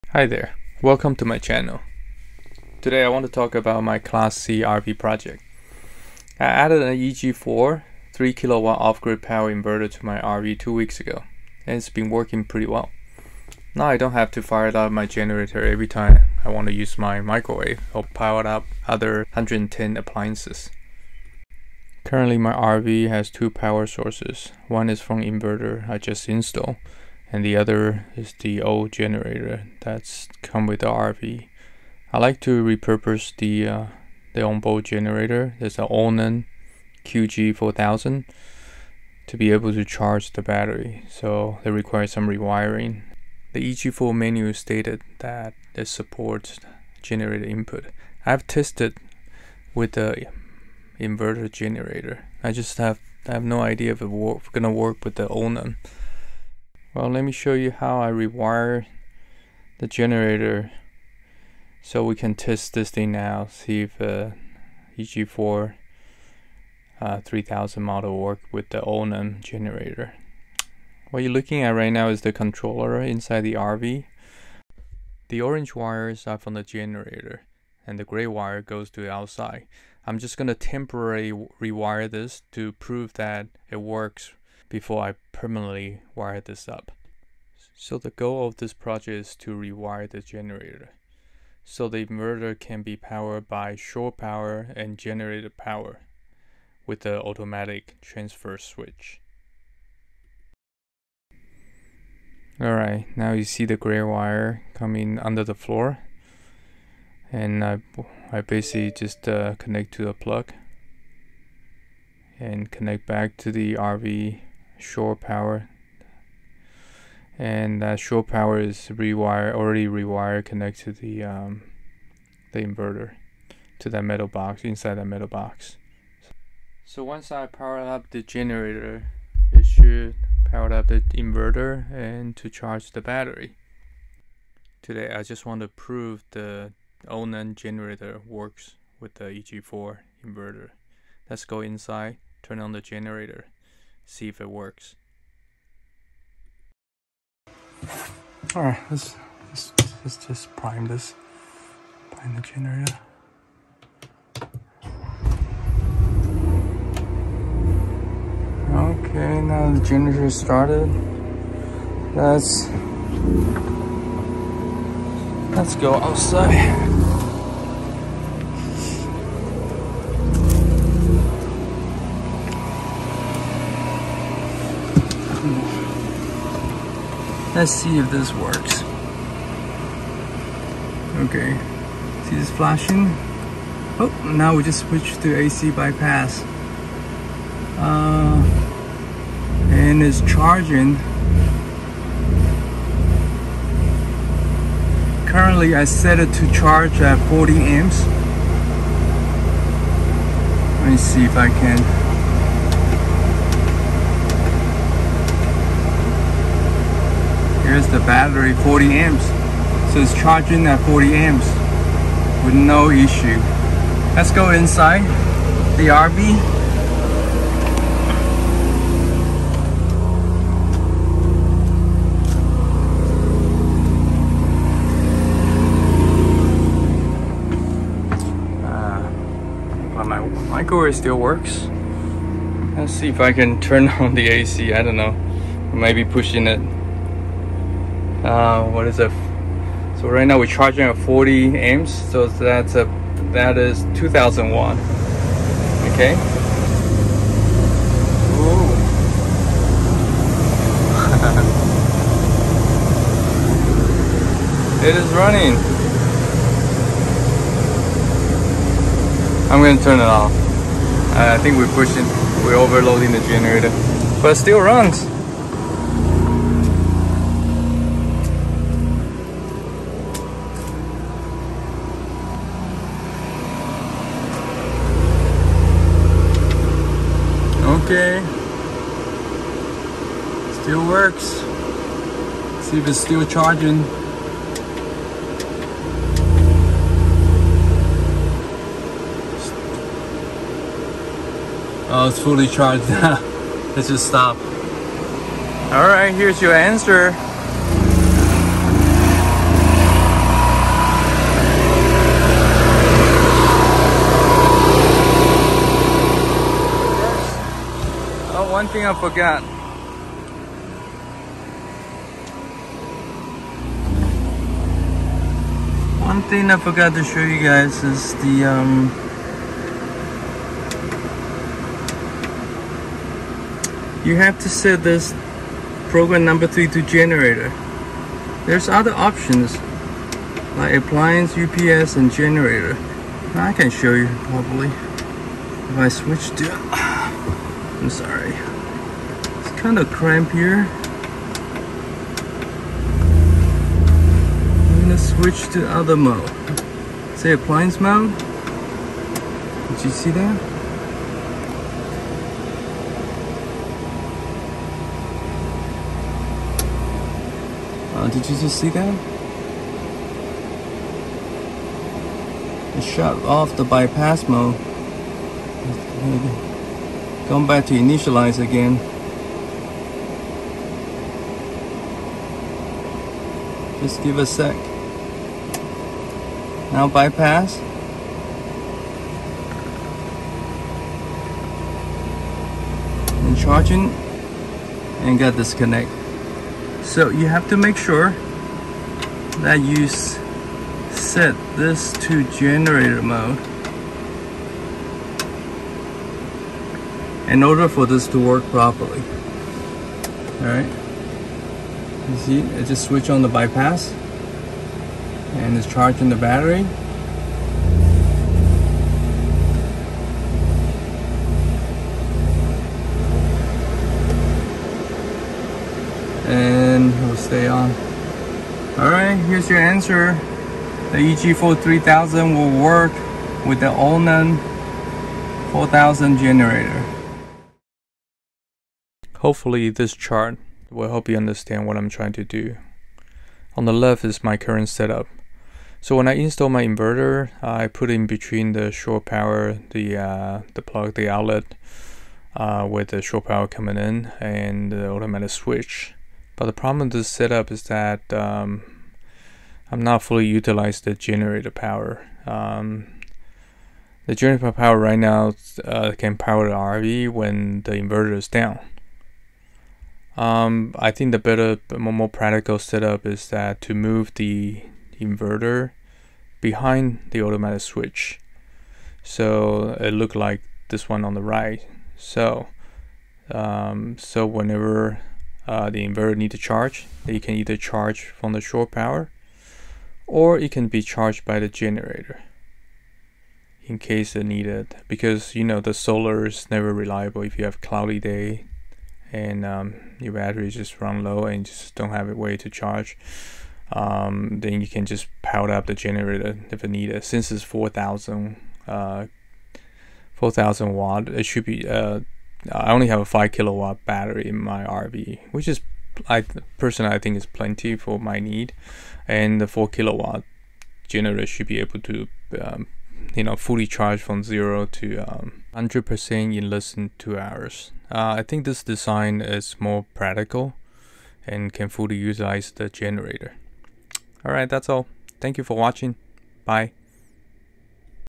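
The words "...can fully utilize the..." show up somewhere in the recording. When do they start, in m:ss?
8:41.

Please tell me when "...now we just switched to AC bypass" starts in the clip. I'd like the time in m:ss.
3:04.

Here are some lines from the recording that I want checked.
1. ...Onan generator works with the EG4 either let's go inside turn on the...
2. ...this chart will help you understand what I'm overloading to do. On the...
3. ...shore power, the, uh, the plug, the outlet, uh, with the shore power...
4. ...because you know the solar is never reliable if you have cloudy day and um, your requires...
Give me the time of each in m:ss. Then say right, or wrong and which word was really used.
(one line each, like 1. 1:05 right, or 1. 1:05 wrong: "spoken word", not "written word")
1. 2:17 wrong: "inverter", not "either"
2. 7:09 wrong: "trying", not "overloading"
3. 7:18 right
4. 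8:04 wrong: "batteries", not "requires".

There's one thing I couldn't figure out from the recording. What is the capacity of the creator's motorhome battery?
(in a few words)
5 kilowatt.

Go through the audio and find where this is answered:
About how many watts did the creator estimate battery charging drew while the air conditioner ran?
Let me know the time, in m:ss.
4:03.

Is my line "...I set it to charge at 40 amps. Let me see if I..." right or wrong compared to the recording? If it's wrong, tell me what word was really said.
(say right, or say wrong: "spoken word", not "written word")
right.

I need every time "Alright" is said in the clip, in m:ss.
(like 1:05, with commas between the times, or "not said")
1:42, 8:44.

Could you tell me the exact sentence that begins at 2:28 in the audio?
All right, let's, let's, let's just prime this, prime the generator.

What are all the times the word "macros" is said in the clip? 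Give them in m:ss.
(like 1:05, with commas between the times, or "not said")
not said.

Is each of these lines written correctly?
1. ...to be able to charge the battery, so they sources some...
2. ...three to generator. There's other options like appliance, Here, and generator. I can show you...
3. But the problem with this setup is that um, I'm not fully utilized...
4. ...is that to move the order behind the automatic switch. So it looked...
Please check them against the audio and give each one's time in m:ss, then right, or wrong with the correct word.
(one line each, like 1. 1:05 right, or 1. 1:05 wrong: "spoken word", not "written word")
1. 0:39 wrong: "requires", not "sources"
2. 5:26 wrong: "UPS", not "Here"
3. 7:26 right
4. 7:43 wrong: "inverter", not "order".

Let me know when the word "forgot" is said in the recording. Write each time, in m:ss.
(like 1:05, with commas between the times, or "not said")
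5:08, 5:16.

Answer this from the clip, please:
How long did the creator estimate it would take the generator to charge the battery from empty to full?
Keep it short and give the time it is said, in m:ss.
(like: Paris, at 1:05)
less than two hours, at 8:36.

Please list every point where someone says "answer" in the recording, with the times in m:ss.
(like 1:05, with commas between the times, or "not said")
4:56, 6:59.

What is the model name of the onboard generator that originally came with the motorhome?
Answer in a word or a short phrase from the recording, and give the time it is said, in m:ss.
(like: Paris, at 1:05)
Onan QG4000, at 0:35.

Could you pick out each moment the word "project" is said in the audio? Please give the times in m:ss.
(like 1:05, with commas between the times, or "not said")
0:04, 1:28.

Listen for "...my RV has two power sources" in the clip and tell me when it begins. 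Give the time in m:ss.
0:22.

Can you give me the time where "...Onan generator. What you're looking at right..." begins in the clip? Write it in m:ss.
1:08.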